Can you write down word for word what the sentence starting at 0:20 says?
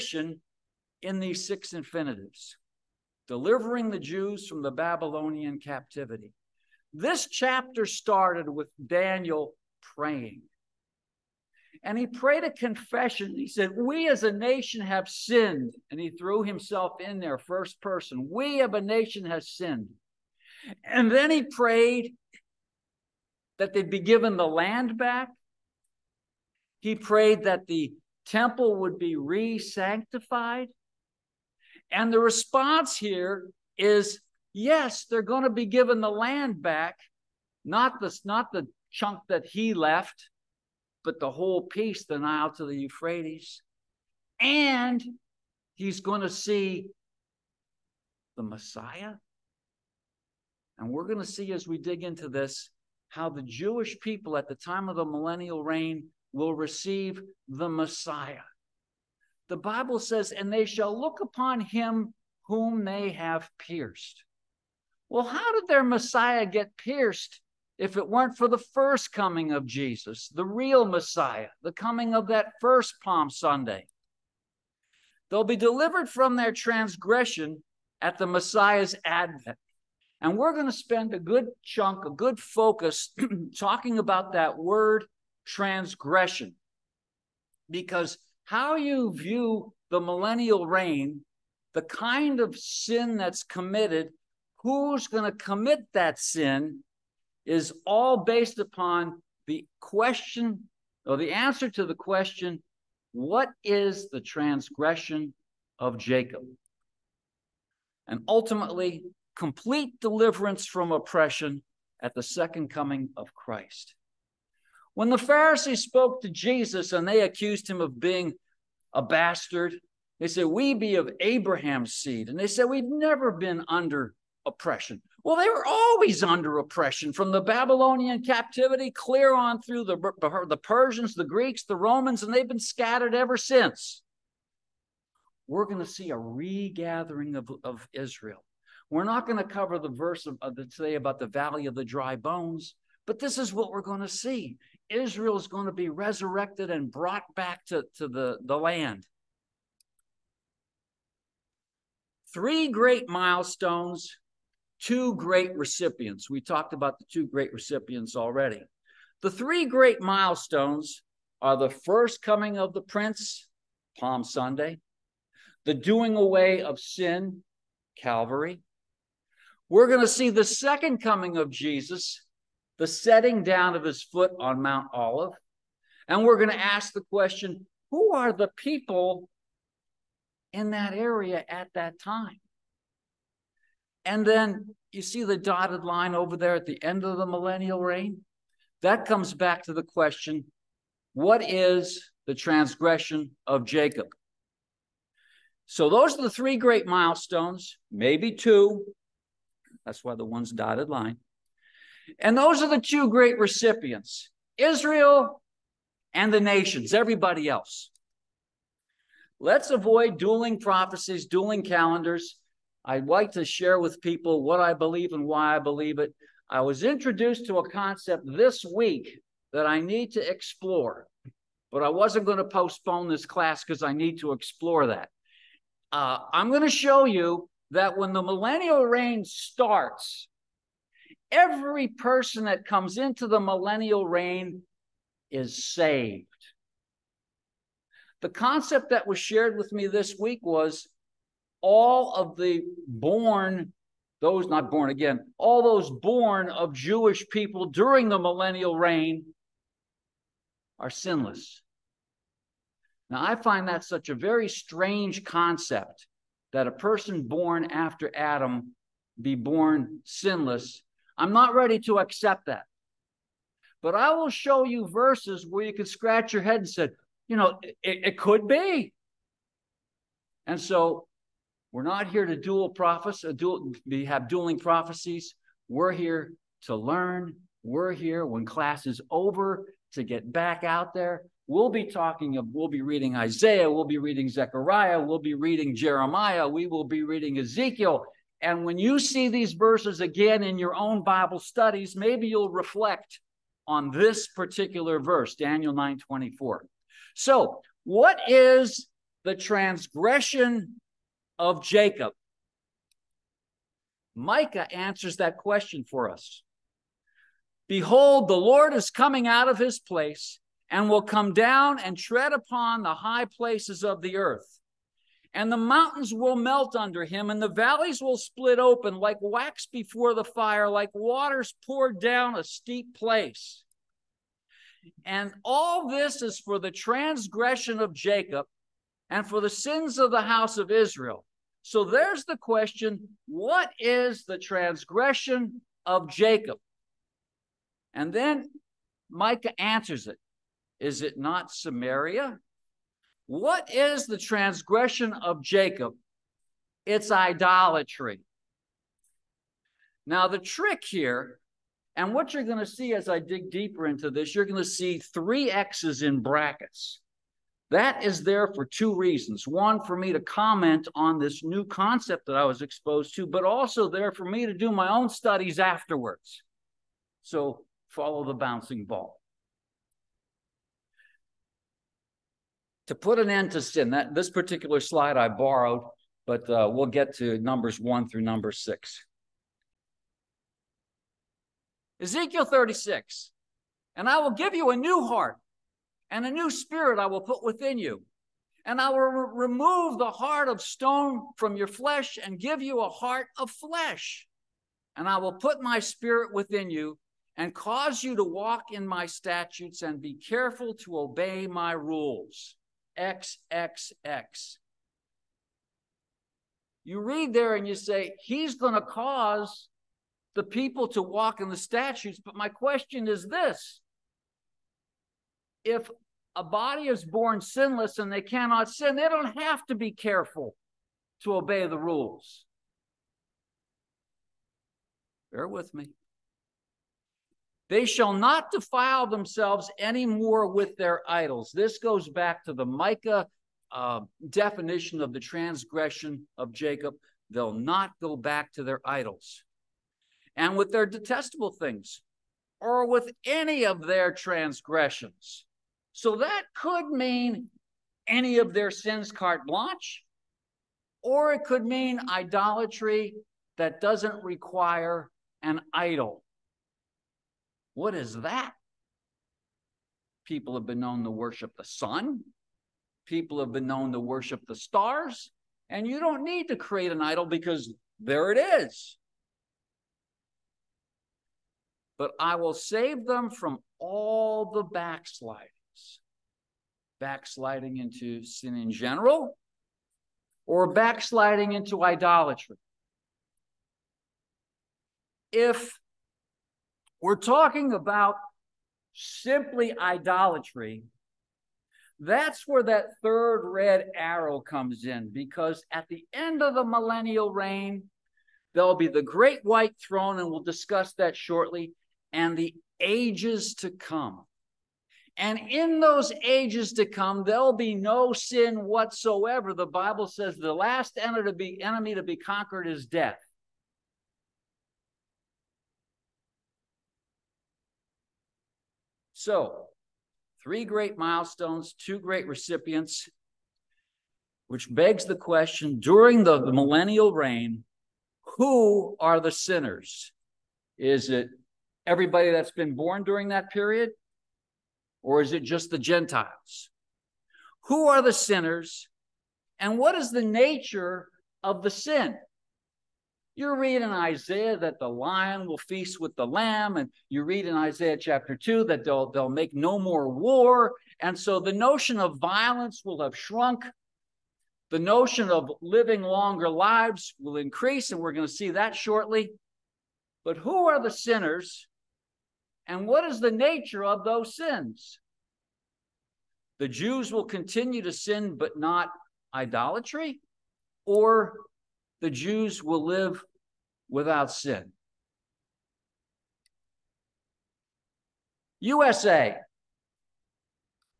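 And then he prayed that they'd be given the land back.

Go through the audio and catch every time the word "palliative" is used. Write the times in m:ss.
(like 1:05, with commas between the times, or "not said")
not said.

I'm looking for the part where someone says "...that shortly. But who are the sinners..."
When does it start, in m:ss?
9:18.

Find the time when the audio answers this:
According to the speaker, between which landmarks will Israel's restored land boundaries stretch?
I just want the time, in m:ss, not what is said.
0:42.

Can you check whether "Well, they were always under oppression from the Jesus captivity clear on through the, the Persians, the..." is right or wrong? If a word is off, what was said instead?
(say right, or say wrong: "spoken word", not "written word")
wrong: "Babylonian", not "Jesus".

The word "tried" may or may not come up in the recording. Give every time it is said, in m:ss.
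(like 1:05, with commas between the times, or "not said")
not said.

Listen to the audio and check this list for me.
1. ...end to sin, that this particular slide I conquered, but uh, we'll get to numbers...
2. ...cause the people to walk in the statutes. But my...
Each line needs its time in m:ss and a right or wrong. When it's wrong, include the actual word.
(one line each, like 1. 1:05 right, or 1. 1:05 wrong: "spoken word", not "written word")
1. 6:13 wrong: "borrowed", not "conquered"
2. 6:48 right.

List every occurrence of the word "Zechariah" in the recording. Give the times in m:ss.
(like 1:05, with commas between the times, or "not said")
4:44.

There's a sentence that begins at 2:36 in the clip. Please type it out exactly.
We talked about the two great recipients already.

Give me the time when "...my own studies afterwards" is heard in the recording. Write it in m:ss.
6:04.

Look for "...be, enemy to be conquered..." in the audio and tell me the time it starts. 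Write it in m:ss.
8:31.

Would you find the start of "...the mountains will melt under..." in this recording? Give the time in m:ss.
5:15.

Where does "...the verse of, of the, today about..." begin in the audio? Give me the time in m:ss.
2:19.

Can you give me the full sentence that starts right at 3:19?
That's why the one's dotted line.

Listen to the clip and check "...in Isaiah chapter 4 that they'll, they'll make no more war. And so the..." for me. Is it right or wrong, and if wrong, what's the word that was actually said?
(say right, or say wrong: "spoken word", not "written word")
wrong: "2", not "4".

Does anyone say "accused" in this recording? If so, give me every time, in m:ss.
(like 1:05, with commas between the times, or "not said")
1:57.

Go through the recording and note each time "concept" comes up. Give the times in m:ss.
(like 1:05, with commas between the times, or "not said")
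3:37, 3:58, 4:15, 6:01.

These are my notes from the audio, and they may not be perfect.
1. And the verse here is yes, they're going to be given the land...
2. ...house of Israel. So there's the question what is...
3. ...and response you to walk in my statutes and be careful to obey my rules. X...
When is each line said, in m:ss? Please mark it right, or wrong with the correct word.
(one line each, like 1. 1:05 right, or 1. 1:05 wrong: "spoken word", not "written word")
1. 0:31 wrong: "response", not "verse"
2. 5:30 right
3. 6:37 wrong: "cause", not "response".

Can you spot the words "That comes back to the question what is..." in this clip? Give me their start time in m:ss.
3:08.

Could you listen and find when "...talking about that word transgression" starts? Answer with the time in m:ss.
1:23.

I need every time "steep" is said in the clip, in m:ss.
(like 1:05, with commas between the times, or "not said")
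5:22.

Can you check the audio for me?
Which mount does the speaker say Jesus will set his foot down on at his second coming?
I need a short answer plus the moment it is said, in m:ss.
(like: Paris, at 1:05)
Mount Olive, at 2:54.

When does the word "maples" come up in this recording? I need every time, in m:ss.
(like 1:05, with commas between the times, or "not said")
not said.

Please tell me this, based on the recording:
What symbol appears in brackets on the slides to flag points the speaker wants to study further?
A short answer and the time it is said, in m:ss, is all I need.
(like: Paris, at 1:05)
Three X's, at 5:54.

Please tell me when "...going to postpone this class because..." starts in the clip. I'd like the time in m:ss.
3:42.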